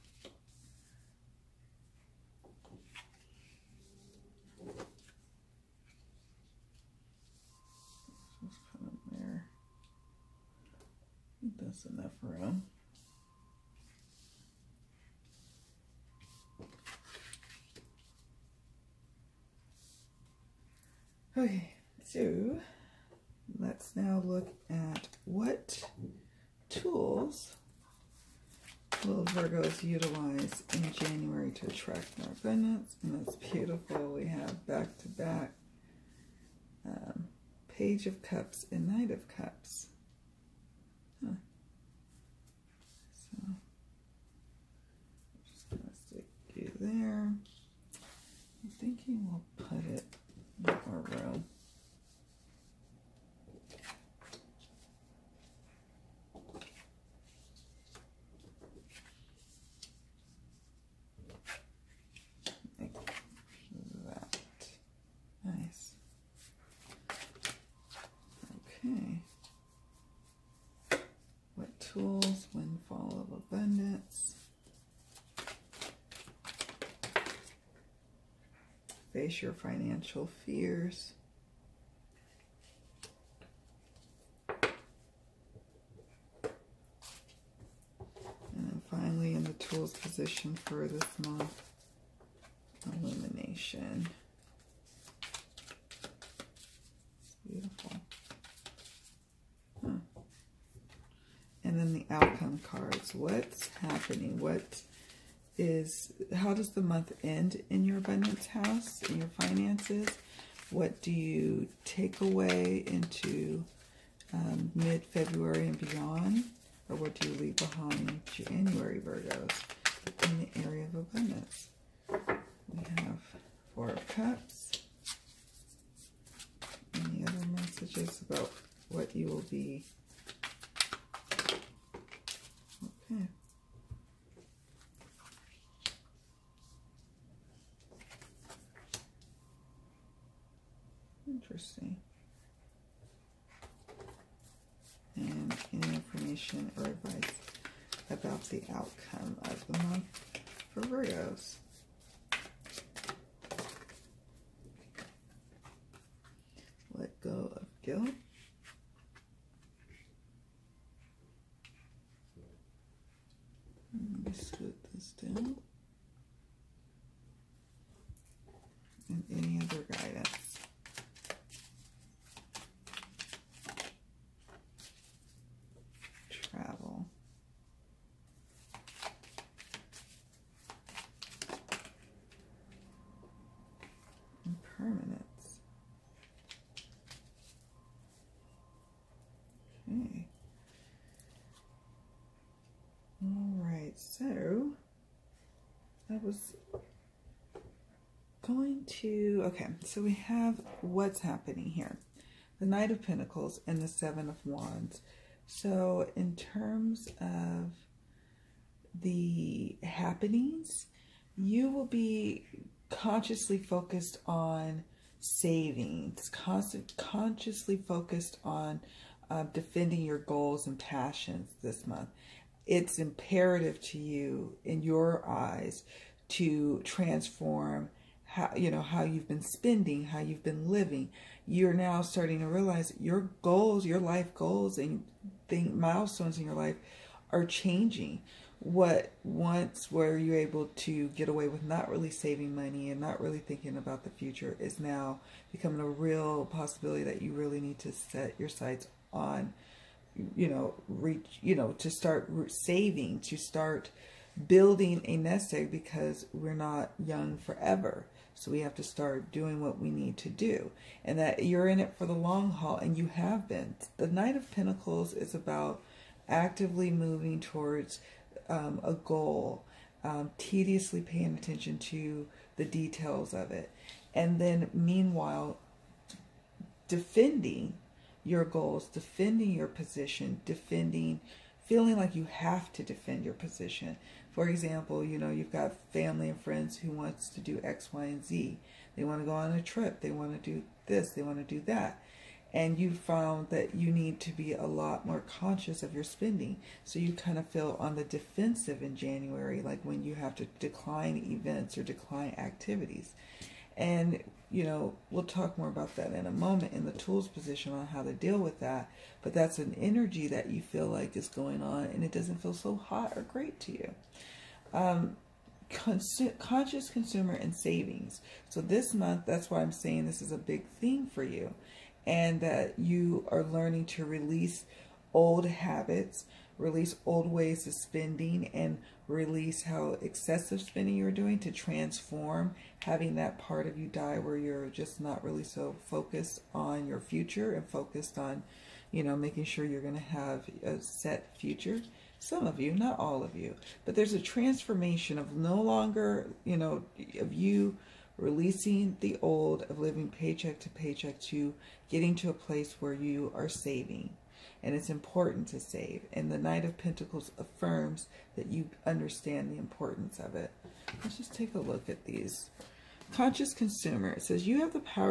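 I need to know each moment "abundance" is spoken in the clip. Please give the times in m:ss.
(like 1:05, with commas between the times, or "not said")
0:32, 1:47, 2:01.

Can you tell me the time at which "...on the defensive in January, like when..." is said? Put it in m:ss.
4:57.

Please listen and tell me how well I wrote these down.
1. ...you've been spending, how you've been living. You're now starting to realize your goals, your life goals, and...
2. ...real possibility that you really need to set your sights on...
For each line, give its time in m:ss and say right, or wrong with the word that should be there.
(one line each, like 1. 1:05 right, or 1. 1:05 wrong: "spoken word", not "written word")
1. 3:49 right
2. 4:05 right.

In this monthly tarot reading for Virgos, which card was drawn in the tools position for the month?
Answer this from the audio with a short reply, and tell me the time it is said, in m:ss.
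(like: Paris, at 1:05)
Illumination, at 1:33.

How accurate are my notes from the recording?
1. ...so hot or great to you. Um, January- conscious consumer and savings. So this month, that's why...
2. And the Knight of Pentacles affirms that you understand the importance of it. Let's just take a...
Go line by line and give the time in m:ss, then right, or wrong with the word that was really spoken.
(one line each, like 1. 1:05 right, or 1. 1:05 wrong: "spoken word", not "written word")
1. 5:12 wrong: "Consu", not "January"
2. 5:56 right.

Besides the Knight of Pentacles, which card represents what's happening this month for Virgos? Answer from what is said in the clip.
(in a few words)
Seven of Wands.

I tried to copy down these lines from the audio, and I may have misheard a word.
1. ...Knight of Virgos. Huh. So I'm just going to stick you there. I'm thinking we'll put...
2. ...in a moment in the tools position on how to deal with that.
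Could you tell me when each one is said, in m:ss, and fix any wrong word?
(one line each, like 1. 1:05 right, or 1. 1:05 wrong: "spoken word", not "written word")
1. 0:38 wrong: "Cups", not "Virgos"
2. 5:06 right.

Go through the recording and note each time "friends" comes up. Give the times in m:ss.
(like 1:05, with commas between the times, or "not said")
4:46.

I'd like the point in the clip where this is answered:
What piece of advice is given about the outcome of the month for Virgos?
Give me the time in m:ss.
2:36.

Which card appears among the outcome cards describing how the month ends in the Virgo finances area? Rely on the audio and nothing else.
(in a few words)
Four of Cups.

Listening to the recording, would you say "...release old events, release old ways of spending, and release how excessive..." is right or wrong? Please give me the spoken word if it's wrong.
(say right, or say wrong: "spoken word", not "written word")
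wrong: "habits", not "events".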